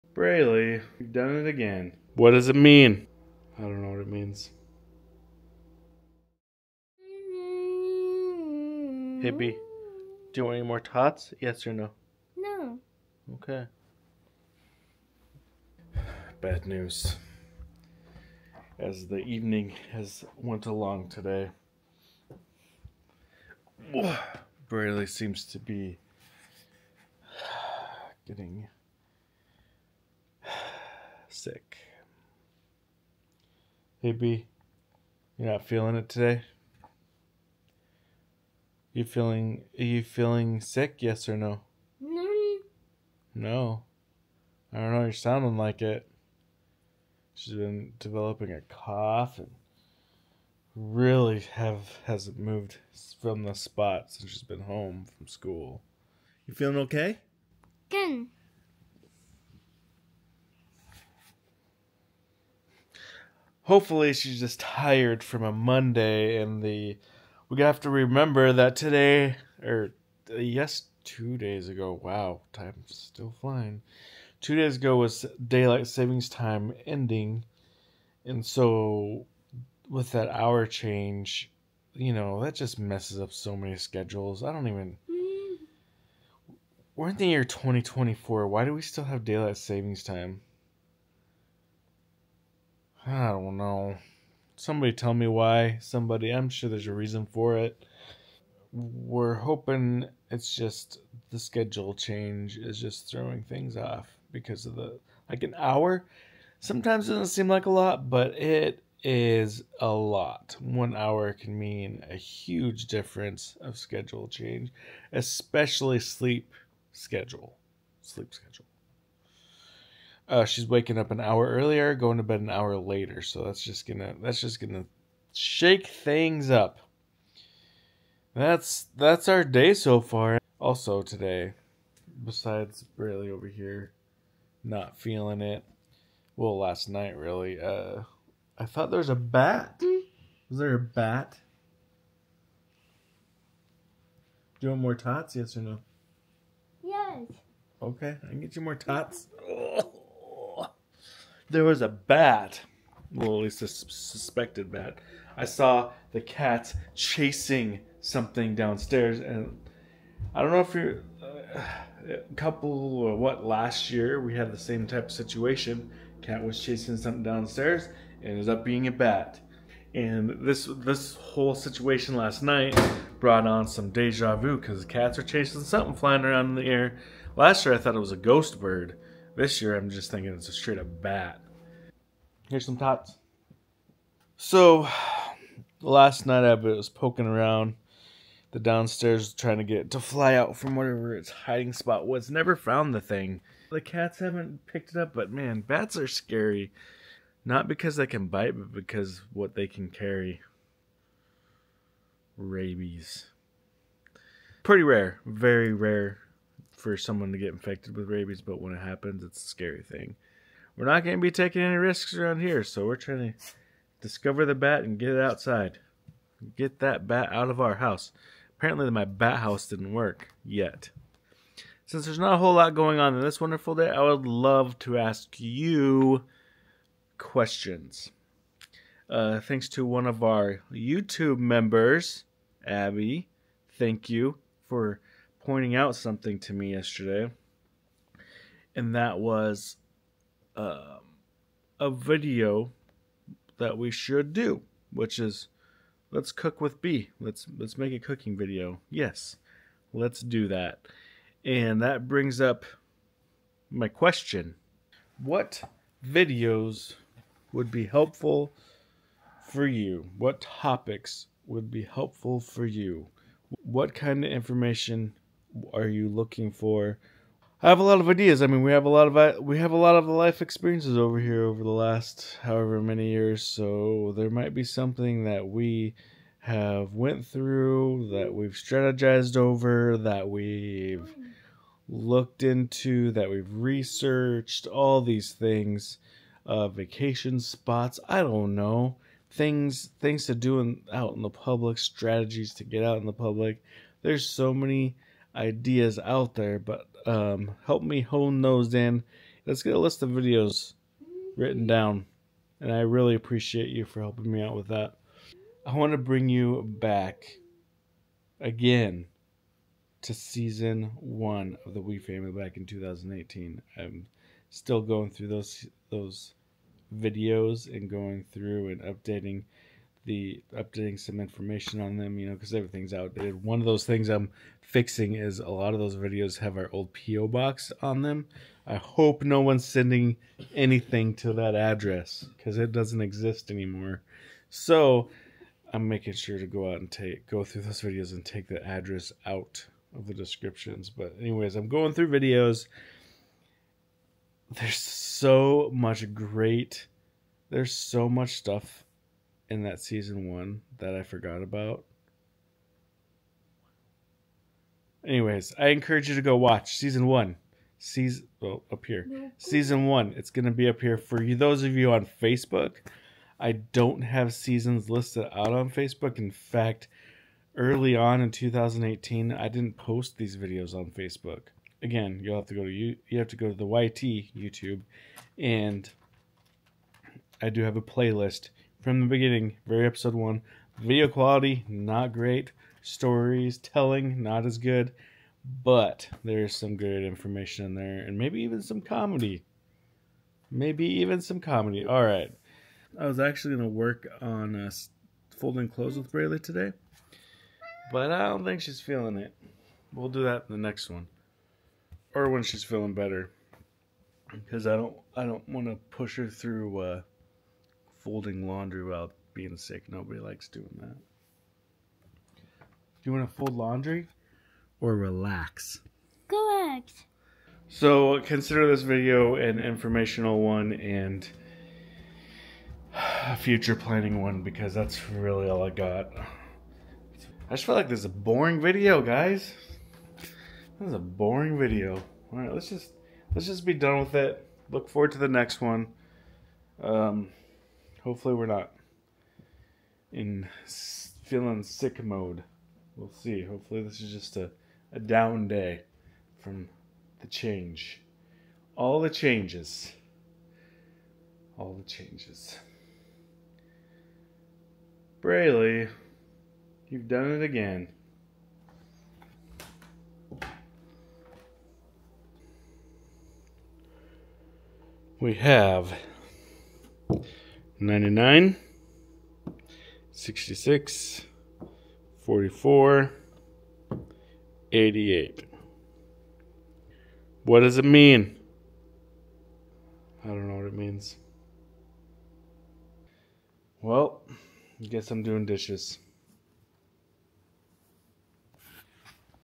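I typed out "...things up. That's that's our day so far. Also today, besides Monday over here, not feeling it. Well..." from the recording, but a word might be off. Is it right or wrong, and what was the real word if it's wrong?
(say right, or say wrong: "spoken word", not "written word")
wrong: "Braylee", not "Monday".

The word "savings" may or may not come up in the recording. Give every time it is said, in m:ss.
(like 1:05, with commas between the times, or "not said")
1:15, 1:29.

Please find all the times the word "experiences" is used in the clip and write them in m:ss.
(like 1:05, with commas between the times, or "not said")
4:30.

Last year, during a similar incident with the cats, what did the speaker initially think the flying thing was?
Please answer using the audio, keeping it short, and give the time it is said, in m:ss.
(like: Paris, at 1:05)
ghost bird, at 2:58.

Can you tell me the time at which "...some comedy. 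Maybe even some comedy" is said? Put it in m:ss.
6:28.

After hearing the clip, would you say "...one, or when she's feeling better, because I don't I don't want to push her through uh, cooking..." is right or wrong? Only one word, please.
wrong.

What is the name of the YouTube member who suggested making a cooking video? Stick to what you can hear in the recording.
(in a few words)
Abby.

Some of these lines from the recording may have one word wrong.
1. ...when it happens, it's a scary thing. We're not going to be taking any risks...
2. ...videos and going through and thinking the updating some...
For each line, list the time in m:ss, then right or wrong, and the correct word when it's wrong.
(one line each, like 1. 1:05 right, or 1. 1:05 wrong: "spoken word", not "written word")
1. 3:28 right
2. 5:16 wrong: "updating", not "thinking".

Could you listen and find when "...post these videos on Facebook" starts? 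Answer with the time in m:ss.
6:09.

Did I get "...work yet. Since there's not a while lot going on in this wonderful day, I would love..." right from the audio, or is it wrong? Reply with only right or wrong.
wrong.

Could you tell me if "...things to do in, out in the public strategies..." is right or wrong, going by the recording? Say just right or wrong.
right.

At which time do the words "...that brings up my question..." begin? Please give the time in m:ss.
4:11.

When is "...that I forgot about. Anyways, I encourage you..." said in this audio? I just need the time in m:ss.
5:50.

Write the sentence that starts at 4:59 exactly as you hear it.
Let's get a list of videos written down, and I really appreciate you for helping me out with that.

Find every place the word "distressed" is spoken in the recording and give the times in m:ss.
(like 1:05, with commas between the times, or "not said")
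not said.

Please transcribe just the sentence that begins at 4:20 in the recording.
What topics would be helpful for you?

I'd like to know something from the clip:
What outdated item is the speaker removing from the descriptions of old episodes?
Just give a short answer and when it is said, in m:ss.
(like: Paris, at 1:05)
PO box, at 5:26.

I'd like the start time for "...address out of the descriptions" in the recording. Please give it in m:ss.
5:38.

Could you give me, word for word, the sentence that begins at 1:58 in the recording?
Sleep schedule uh, she's waking up an hour earlier, going to bed an hour later.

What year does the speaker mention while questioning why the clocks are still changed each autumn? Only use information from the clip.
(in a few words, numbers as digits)
2024.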